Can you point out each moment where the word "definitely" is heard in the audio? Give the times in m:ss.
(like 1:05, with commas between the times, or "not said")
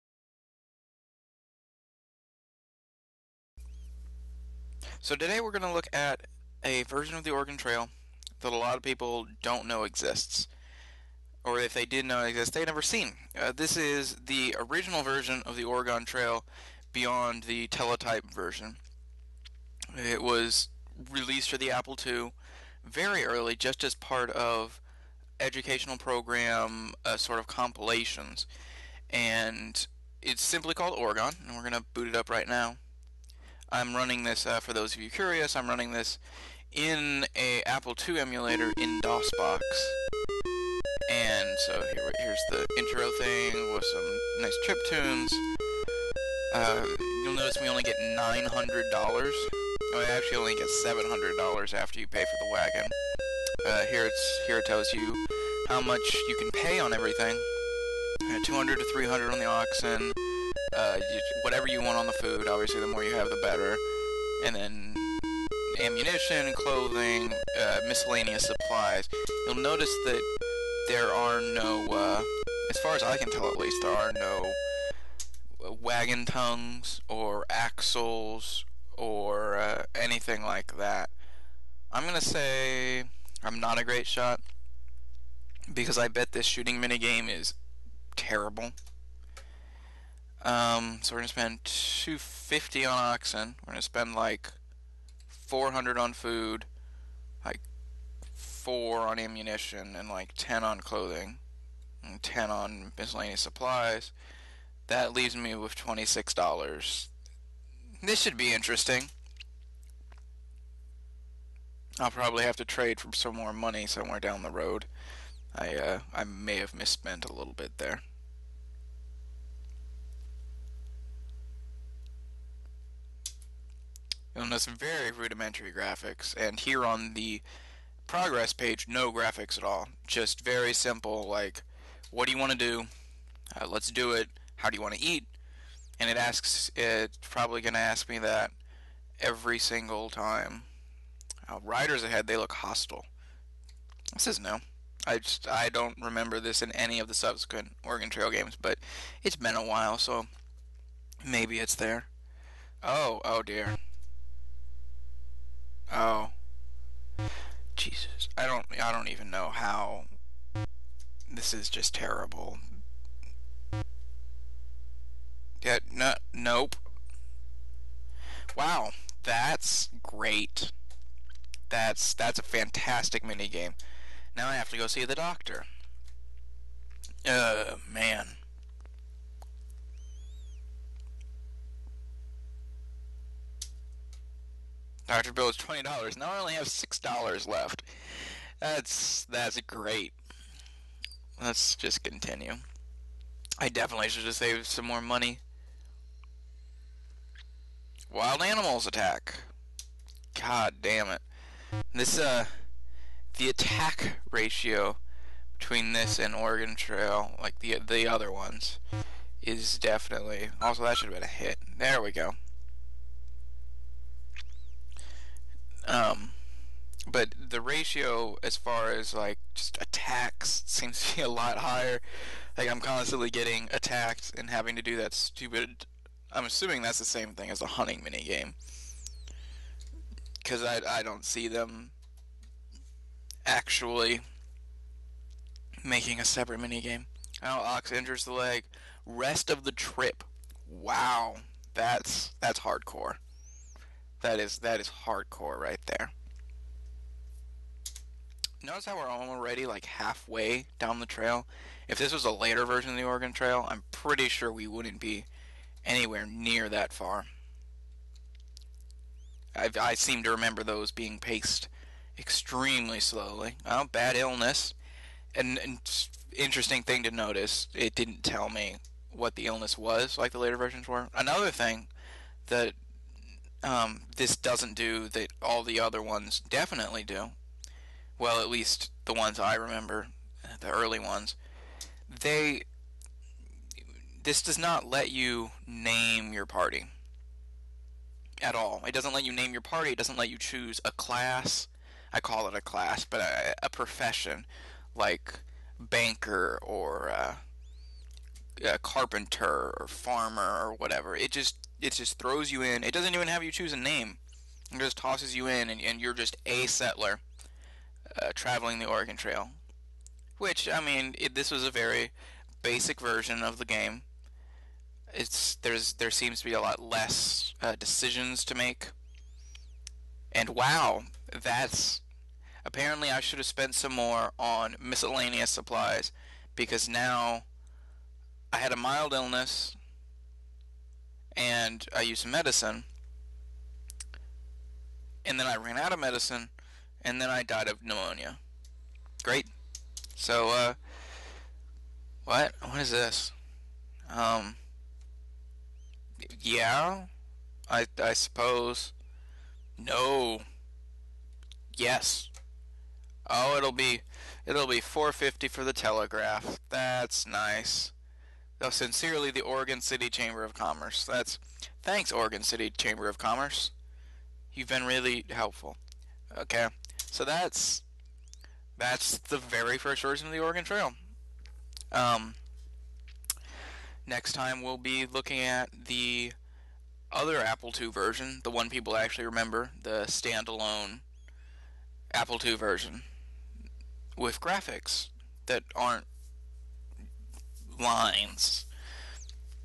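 3:13, 3:29, 4:36.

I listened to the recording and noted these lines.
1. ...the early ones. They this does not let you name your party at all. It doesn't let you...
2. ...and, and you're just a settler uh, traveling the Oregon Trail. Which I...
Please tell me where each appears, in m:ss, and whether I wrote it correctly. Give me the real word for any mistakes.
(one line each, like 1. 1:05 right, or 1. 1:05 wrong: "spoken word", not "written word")
1. 4:40 right
2. 5:05 right.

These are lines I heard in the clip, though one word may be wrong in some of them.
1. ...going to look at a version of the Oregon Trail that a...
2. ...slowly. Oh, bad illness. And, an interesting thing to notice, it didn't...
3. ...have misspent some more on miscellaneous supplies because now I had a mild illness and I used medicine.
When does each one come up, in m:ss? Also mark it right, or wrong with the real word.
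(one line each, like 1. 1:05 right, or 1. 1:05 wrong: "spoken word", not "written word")
1. 0:05 right
2. 4:23 right
3. 5:23 wrong: "spent", not "misspent".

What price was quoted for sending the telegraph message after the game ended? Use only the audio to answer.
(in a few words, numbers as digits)
$450.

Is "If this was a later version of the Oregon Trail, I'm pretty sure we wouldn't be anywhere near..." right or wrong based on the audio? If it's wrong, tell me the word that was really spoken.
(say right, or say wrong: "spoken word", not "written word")
right.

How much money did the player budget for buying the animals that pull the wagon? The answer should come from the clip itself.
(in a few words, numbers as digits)
$250.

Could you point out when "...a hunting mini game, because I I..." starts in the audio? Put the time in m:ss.
3:47.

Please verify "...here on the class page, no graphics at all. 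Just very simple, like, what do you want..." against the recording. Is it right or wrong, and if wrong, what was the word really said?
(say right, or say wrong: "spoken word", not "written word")
wrong: "progress", not "class".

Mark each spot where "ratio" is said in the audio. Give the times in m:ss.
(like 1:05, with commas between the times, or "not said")
3:24, 3:37.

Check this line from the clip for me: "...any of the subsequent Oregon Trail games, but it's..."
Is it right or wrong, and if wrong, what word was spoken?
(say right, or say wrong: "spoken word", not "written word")
right.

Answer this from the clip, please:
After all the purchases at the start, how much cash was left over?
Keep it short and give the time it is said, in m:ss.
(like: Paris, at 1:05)
$26, at 1:45.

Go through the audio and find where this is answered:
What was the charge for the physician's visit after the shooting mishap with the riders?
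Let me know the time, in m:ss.
3:05.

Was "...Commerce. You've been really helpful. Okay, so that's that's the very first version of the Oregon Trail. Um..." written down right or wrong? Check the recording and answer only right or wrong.
right.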